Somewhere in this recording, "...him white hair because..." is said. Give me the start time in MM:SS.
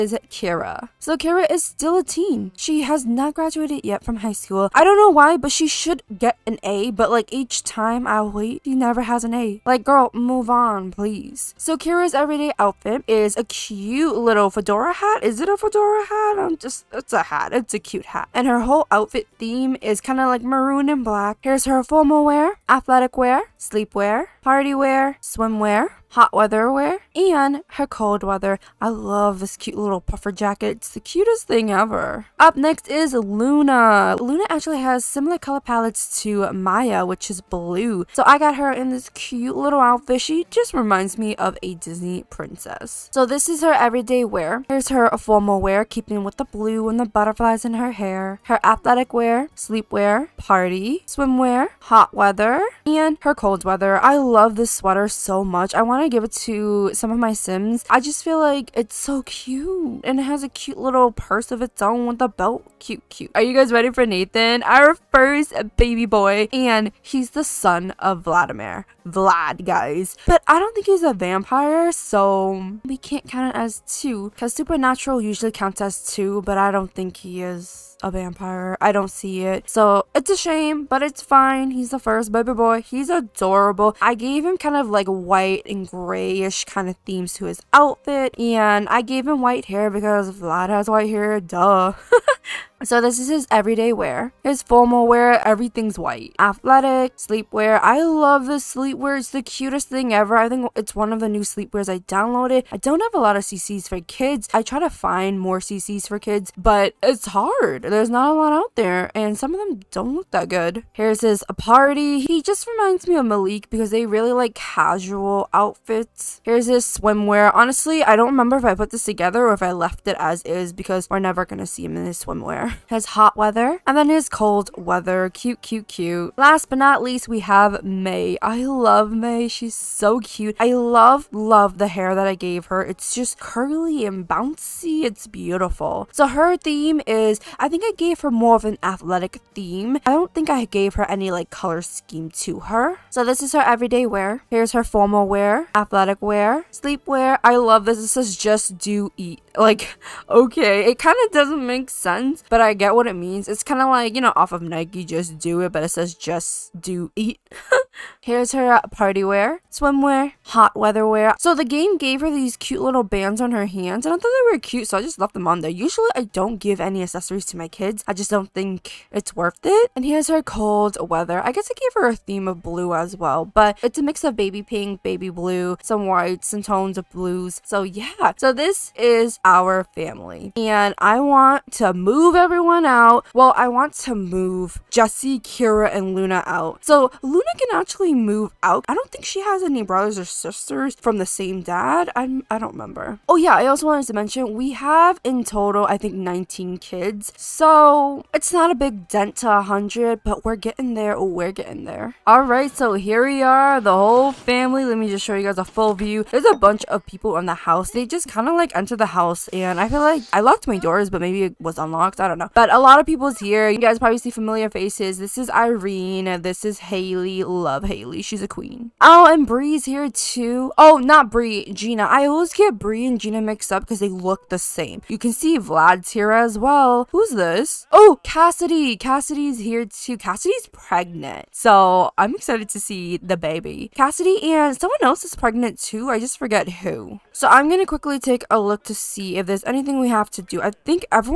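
01:29.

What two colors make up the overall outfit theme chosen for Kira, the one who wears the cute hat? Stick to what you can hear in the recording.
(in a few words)
maroon and black.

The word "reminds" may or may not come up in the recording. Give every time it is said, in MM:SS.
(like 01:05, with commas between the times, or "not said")
00:40, 01:52.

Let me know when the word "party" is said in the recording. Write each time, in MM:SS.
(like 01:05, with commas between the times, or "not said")
00:24, 00:50, 01:51, 02:38.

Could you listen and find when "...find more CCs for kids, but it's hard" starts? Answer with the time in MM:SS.
01:44.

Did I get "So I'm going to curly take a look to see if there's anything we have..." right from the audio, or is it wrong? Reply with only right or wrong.
wrong.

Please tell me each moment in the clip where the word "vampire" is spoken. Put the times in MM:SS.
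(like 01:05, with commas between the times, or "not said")
01:11, 01:18.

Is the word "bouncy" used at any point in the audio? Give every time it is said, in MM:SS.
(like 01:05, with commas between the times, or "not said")
02:14.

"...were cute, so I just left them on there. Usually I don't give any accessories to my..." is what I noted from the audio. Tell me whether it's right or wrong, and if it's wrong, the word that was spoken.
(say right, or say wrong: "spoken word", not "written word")
right.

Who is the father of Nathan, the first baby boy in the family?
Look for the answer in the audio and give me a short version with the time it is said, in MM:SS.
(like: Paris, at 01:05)
Vladimir, at 01:08.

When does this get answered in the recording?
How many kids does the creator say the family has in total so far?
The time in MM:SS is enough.
03:16.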